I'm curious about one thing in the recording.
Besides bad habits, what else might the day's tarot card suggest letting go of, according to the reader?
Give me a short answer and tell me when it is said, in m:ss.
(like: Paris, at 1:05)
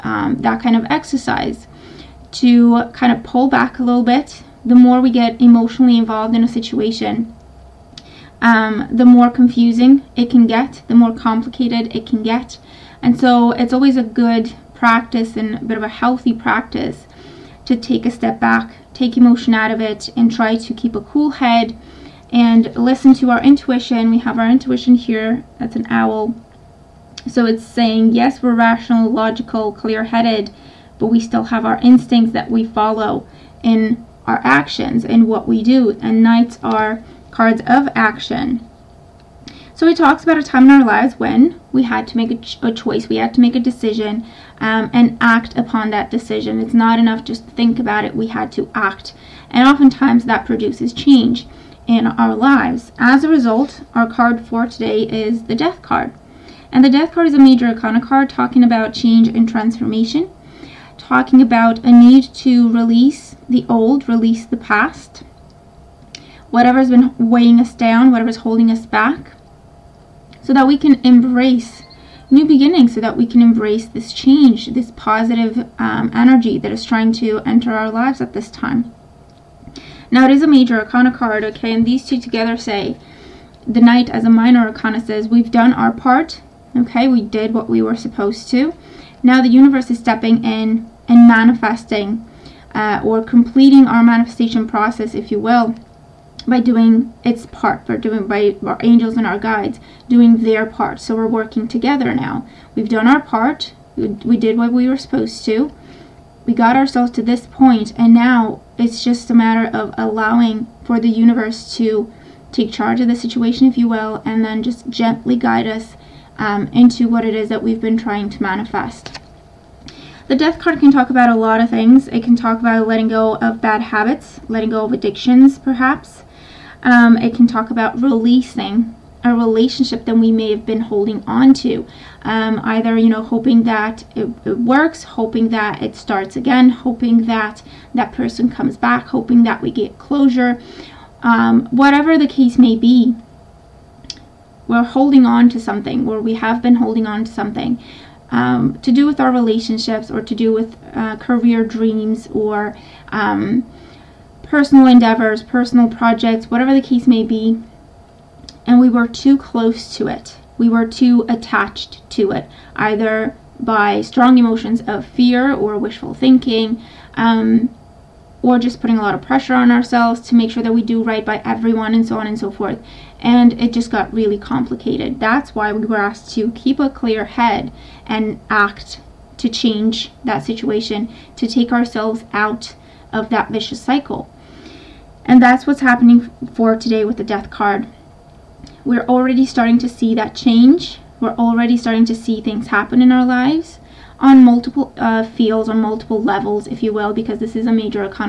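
Addictions, at 2:04.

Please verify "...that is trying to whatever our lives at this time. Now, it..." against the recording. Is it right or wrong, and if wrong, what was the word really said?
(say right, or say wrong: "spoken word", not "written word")
wrong: "enter", not "whatever".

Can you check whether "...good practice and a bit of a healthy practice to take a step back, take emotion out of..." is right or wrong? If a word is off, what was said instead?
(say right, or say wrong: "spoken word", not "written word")
right.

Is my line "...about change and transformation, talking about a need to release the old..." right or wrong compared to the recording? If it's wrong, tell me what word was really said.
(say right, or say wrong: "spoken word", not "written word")
right.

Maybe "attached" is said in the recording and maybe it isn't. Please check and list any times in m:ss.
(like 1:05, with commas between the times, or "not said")
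2:41.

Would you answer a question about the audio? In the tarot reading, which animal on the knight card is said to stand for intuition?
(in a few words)
Owl.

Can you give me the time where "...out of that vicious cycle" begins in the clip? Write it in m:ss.
3:02.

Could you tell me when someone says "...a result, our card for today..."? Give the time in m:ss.
0:53.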